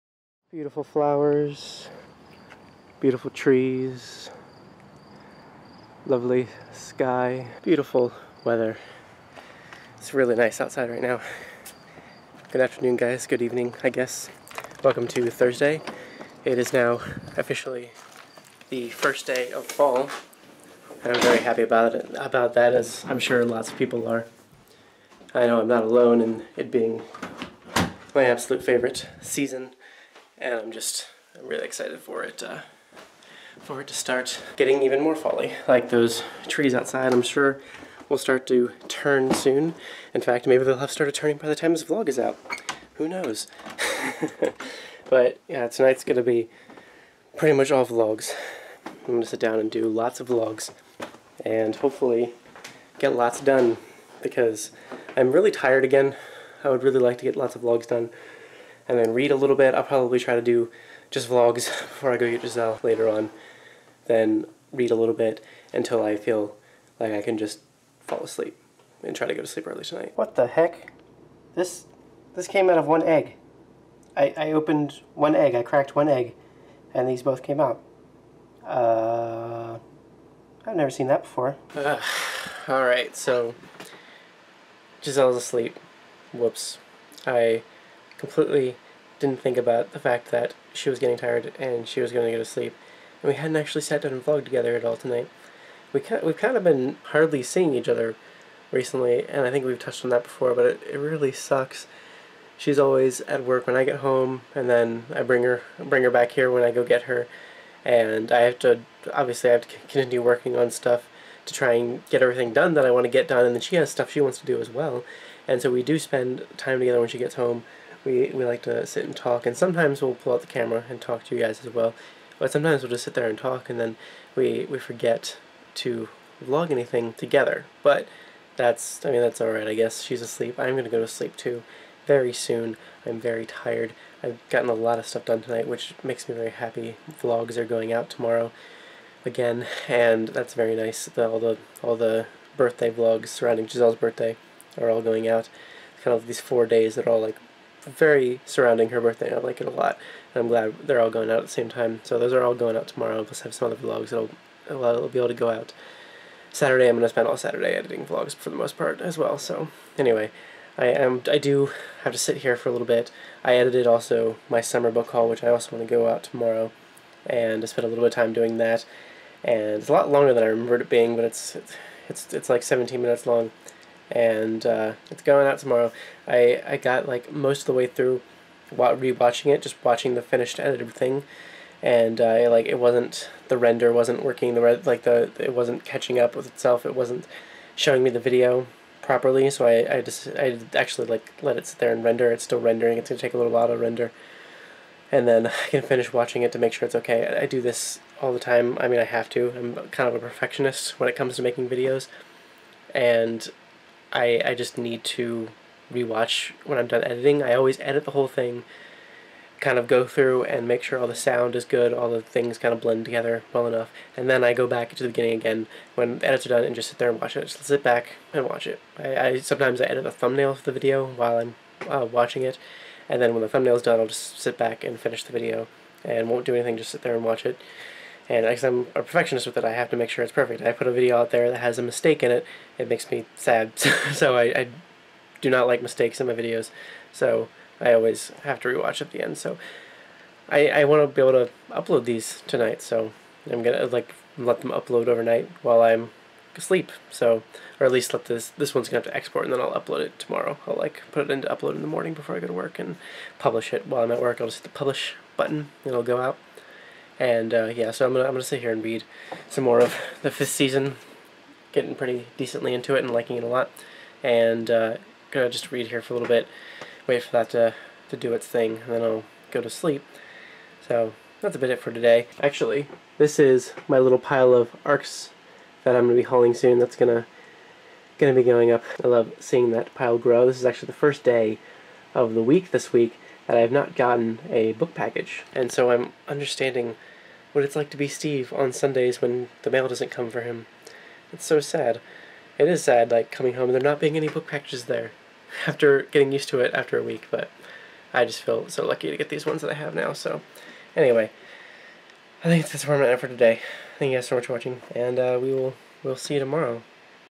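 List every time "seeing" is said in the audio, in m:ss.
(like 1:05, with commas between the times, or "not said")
1:37, 4:39.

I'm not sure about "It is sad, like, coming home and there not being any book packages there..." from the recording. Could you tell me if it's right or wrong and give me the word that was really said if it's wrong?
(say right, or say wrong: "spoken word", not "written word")
right.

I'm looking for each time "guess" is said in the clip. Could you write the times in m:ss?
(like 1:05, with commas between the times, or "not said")
0:13, 2:09.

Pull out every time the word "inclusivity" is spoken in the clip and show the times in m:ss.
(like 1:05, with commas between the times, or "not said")
not said.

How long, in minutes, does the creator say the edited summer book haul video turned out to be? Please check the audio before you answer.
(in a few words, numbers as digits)
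17.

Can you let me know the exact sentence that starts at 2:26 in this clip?
Kind of these four days that are all like very surrounding her birthday.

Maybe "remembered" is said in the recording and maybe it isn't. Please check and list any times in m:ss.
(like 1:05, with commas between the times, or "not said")
2:50.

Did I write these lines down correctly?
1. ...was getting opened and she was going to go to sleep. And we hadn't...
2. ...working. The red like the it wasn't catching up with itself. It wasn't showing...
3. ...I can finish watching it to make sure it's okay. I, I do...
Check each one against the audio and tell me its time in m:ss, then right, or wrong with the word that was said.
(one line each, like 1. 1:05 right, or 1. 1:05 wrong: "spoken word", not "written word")
1. 1:30 wrong: "tired", not "opened"
2. 3:04 right
3. 3:15 right.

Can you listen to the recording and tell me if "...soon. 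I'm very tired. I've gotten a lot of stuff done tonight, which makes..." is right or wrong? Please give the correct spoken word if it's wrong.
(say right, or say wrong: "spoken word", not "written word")
right.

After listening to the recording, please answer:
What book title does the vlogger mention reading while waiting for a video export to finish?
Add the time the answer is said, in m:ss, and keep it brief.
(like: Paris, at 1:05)
The Fifth Season, at 4:20.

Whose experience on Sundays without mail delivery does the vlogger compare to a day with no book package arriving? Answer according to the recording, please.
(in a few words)
Steve.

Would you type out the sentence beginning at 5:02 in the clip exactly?
I think that's where I'm at for today.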